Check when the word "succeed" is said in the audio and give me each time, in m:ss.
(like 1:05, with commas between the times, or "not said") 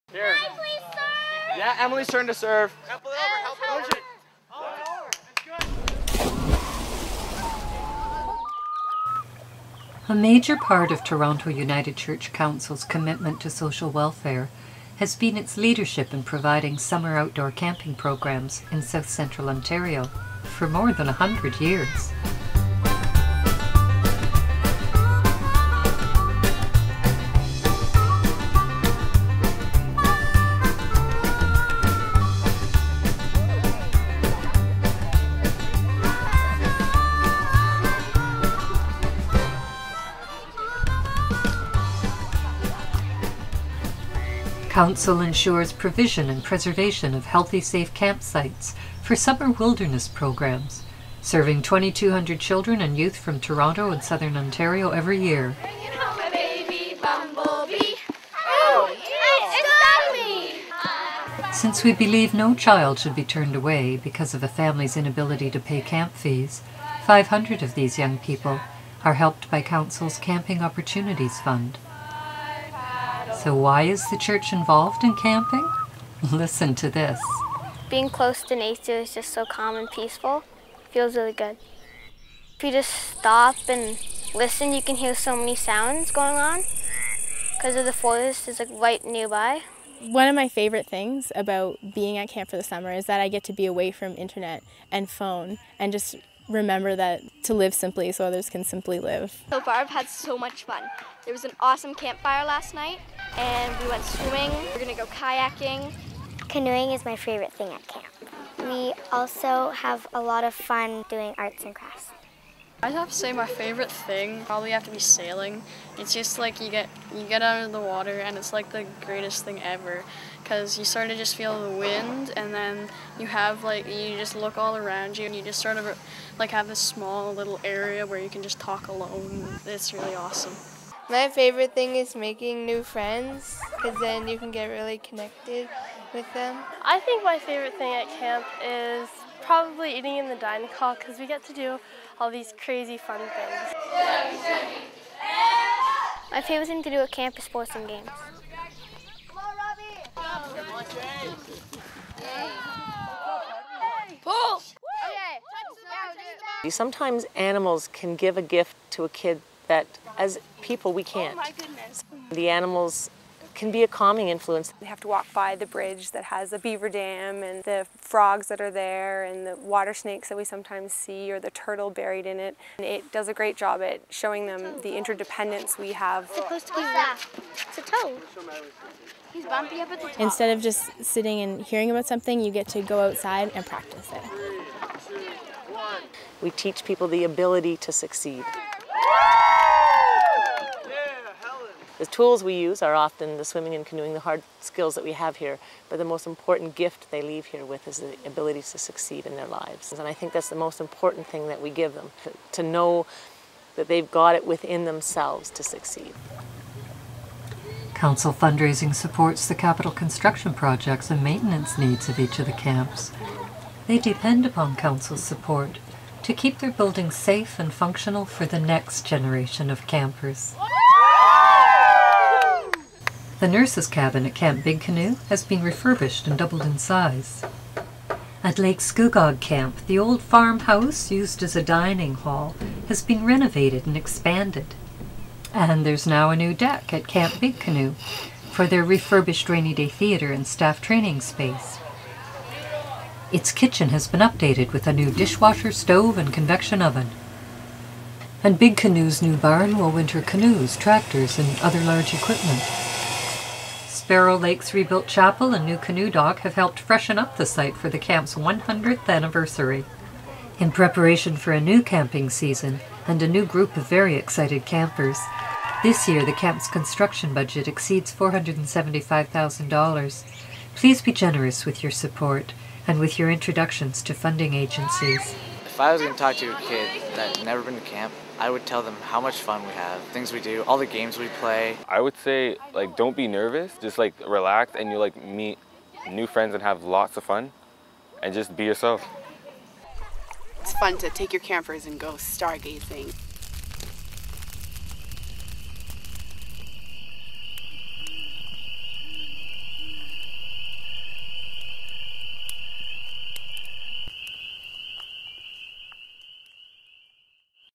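3:07, 3:18, 3:25.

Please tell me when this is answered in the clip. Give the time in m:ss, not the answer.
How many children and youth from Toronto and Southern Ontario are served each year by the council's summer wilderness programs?
0:51.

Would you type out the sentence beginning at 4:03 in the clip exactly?
Its kitchen has been updated with a new dishwasher, stove, and convection oven.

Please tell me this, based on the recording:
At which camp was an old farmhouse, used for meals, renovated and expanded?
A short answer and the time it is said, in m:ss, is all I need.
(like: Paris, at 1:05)
Lake Scugog Camp, at 3:48.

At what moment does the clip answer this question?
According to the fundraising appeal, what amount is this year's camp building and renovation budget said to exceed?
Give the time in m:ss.
4:28.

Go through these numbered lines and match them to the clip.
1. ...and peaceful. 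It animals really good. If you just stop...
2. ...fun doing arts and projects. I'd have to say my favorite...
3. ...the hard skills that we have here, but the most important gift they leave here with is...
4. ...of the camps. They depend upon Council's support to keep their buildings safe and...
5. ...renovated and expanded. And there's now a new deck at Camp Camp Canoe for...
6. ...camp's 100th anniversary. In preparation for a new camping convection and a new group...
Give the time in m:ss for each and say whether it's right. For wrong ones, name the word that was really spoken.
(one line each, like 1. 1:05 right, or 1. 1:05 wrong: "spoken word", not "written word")
1. 1:19 wrong: "feels", not "animals"
2. 1:50 wrong: "crafts", not "projects"
3. 3:14 right
4. 3:32 right
5. 3:53 wrong: "Big", not "Camp"
6. 4:17 wrong: "season", not "convection".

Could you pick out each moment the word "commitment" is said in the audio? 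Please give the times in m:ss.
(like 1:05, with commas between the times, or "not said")
0:12.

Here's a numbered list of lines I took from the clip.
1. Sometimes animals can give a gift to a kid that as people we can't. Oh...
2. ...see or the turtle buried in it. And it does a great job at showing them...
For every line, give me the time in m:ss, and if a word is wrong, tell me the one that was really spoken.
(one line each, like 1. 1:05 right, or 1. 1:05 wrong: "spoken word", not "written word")
1. 2:36 right
2. 2:50 right.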